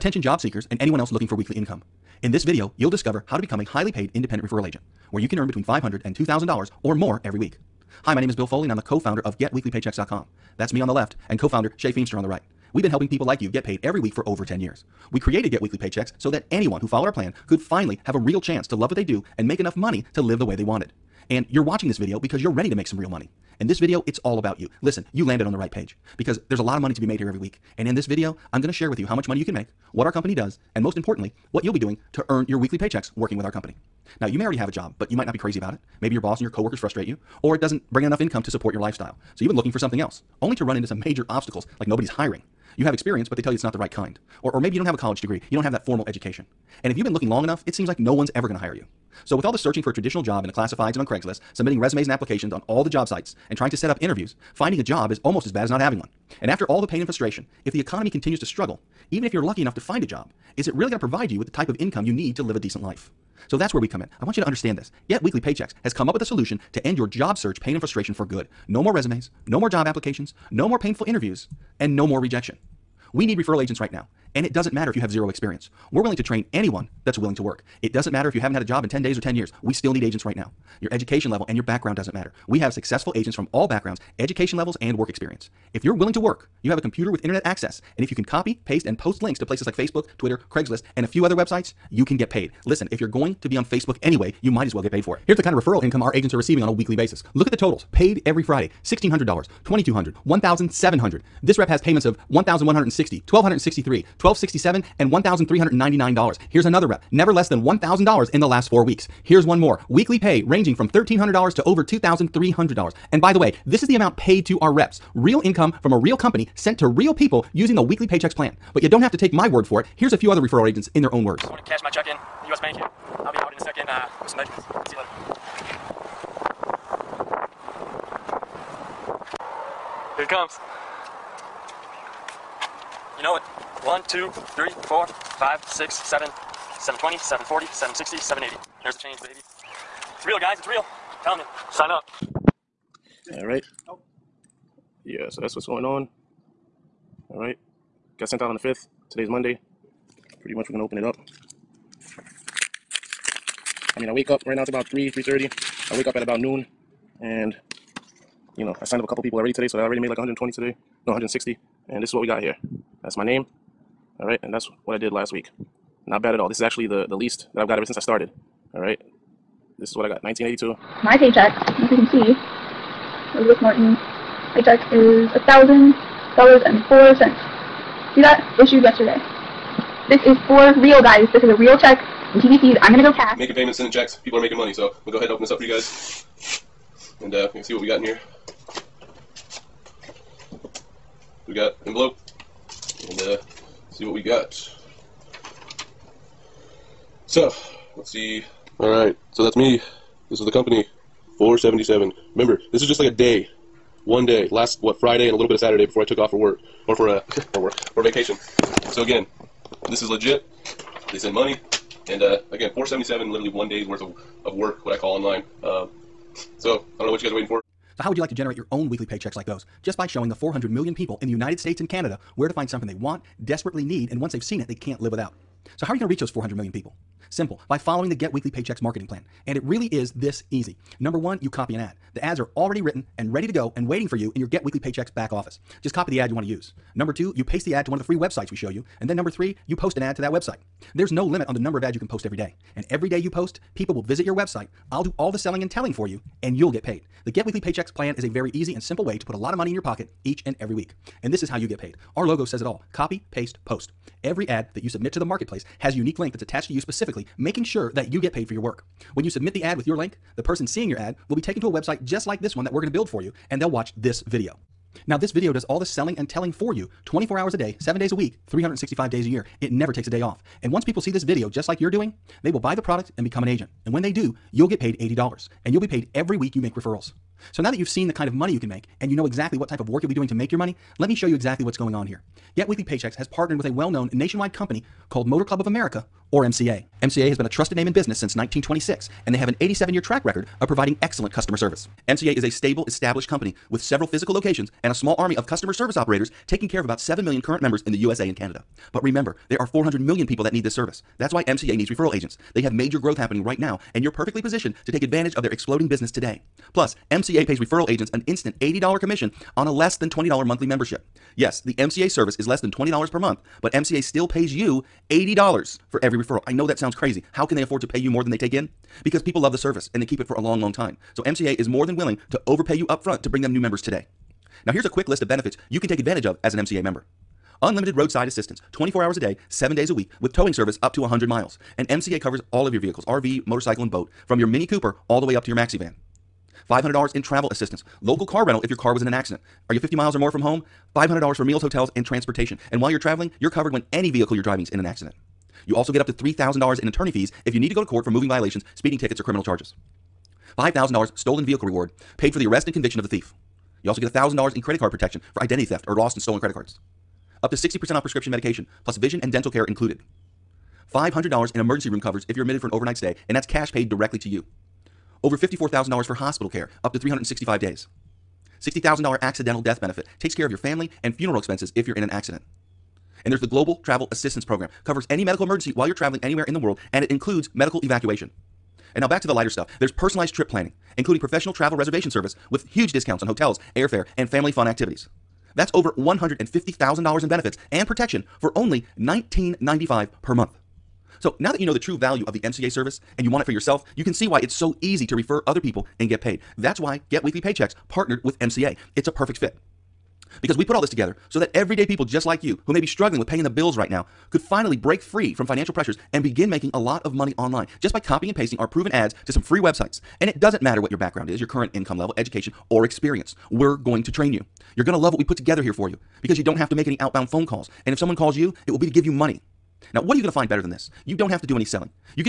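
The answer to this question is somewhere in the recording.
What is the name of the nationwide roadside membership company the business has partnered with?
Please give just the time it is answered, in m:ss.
4:45.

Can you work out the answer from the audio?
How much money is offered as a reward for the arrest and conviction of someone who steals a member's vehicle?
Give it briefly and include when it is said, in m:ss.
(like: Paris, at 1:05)
$5,000, at 5:50.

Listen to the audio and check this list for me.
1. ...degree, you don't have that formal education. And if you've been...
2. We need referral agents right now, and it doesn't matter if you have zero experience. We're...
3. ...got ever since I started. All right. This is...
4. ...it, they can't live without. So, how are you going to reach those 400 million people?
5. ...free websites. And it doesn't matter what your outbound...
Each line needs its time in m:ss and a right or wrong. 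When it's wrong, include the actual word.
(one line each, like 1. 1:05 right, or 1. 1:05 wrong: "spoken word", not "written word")
1. 0:45 right
2. 1:13 right
3. 2:47 right
4. 3:44 right
5. 6:49 wrong: "background", not "outbound".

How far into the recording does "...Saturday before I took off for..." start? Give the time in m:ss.
3:25.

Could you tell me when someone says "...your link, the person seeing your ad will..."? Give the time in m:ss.
4:19.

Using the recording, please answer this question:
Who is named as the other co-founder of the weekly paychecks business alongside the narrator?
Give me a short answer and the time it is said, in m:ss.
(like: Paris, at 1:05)
Shay Feemster, at 0:11.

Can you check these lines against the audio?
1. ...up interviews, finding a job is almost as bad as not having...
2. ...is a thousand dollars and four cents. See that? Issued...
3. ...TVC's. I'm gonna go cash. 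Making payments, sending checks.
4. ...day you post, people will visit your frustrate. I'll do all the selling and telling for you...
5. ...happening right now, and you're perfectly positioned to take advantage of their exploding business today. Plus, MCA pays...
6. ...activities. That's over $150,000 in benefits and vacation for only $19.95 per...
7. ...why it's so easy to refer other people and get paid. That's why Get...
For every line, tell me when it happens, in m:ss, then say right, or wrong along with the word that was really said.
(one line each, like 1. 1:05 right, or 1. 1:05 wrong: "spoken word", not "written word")
1. 0:53 right
2. 2:54 right
3. 3:02 right
4. 4:03 wrong: "website", not "frustrate"
5. 5:03 right
6. 6:24 wrong: "protection", not "vacation"
7. 6:34 right.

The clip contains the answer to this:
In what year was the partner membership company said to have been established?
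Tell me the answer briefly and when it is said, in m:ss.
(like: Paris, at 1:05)
1926, at 4:48.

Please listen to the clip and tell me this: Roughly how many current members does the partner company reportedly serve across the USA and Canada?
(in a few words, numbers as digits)
7 million.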